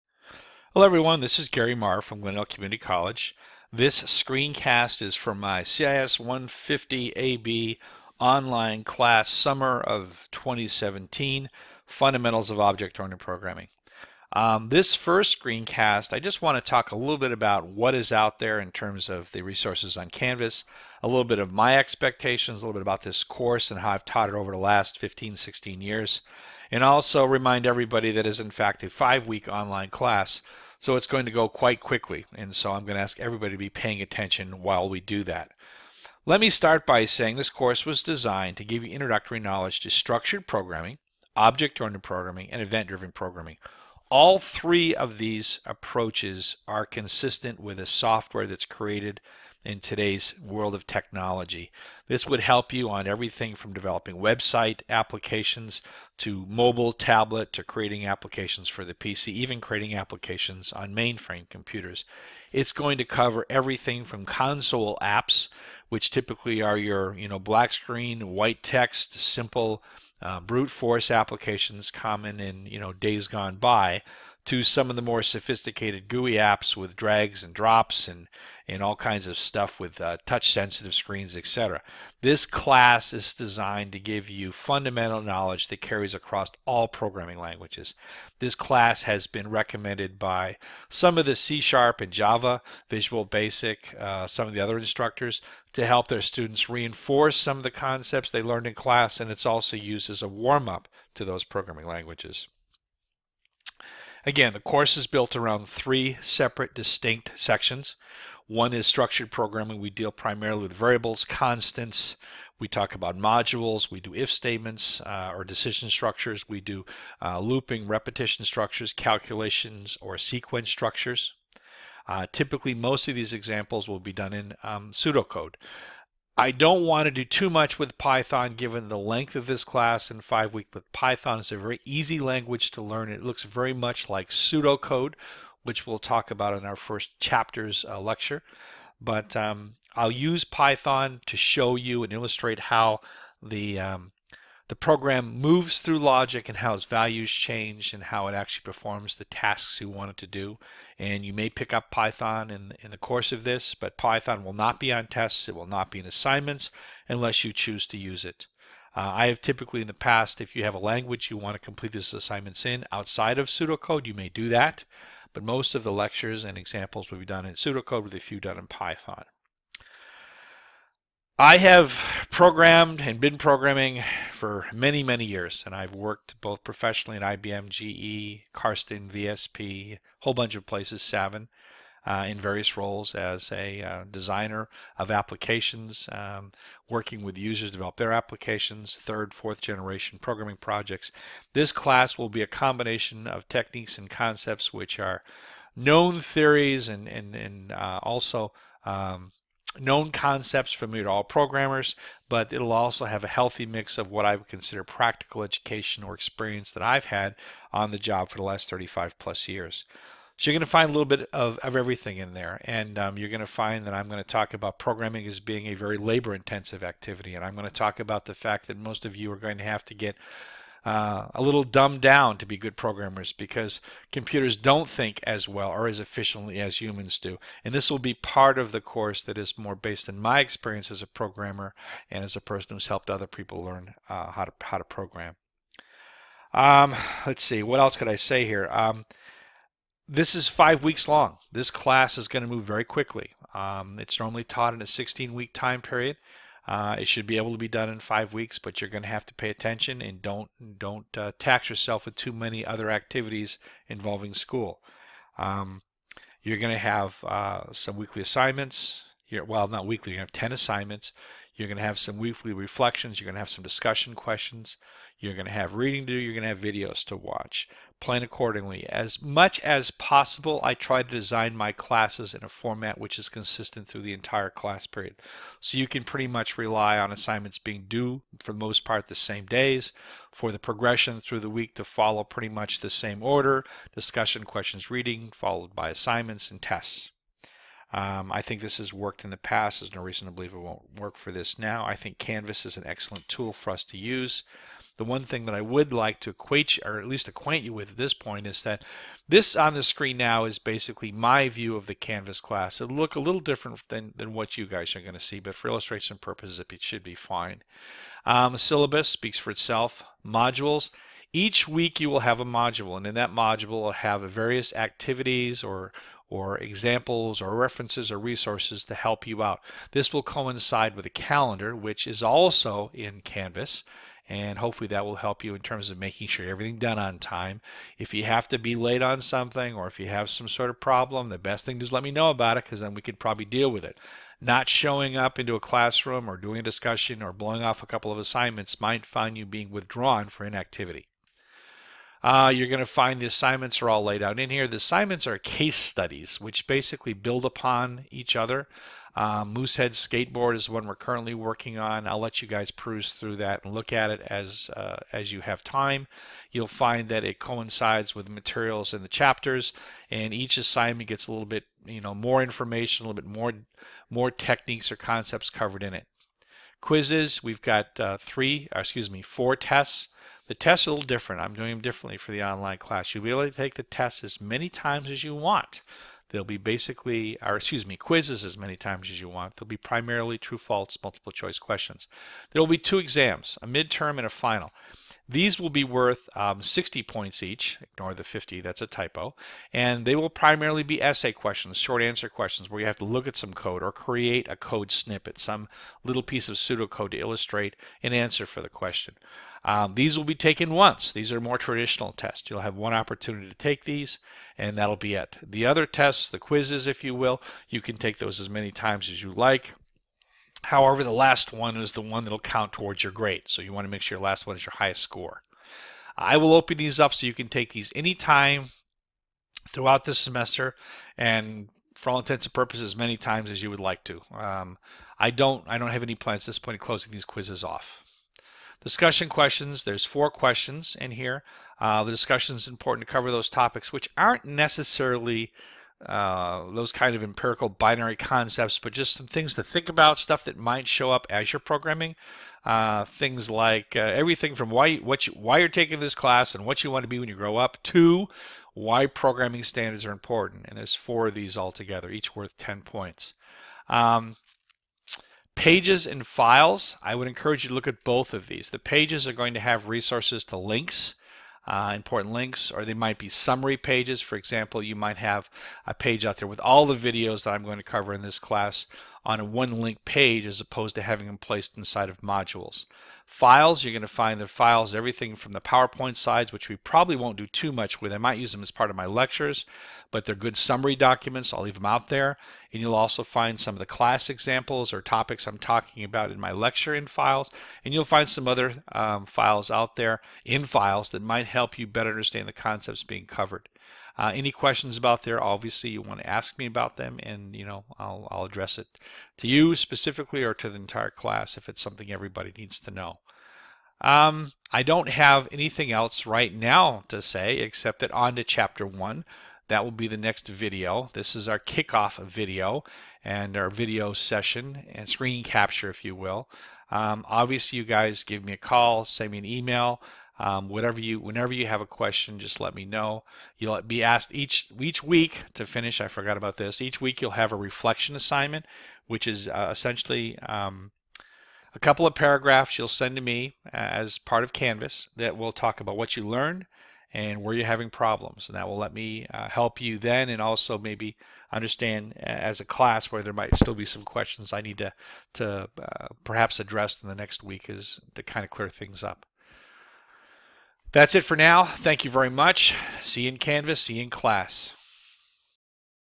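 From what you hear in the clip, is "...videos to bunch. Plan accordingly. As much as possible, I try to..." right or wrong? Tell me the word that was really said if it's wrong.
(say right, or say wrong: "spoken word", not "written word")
wrong: "watch", not "bunch".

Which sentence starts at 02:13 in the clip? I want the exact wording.
It looks very much like pseudocode, which we'll talk about in our first chapters uh, lecture.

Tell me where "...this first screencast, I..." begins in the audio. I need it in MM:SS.
00:14.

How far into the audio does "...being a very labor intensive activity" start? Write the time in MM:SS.
03:35.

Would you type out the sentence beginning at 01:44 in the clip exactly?
Again, the course is built around three separate distinct sections.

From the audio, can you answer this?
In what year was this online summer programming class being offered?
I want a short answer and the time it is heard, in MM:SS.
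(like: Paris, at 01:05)
2017, at 00:10.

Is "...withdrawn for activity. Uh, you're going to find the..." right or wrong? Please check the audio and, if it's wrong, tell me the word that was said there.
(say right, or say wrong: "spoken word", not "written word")
wrong: "inactivity", not "activity".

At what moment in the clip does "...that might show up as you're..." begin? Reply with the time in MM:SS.
07:20.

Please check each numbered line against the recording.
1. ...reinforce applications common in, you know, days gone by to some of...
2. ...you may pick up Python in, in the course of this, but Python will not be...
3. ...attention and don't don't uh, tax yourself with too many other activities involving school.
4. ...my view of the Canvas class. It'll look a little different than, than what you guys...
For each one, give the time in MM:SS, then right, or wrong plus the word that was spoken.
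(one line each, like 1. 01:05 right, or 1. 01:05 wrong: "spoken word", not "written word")
1. 01:10 wrong: "force", not "reinforce"
2. 02:31 right
3. 04:09 right
4. 05:01 right.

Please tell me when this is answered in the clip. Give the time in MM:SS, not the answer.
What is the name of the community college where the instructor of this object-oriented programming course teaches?
00:02.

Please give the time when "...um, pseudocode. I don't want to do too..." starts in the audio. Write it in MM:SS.
02:04.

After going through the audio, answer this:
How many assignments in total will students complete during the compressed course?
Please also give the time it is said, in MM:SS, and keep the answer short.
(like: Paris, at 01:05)
10, at 04:20.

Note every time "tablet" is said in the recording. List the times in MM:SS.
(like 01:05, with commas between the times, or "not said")
00:56.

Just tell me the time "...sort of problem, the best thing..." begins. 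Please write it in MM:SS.
05:30.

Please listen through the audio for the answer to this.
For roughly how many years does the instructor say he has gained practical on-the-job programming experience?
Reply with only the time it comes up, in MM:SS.
03:28.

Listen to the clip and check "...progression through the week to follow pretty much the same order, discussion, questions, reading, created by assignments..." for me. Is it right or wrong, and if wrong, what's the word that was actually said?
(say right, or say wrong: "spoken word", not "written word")
wrong: "followed", not "created".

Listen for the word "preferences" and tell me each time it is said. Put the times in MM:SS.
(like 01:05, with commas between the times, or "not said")
not said.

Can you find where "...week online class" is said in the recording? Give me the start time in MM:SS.
00:29.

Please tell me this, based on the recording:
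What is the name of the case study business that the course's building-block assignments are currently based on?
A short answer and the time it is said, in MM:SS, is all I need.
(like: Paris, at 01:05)
Moosehead Skateboard, at 05:49.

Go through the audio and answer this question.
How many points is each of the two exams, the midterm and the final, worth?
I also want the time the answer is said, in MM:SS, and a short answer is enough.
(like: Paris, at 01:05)
60, at 06:26.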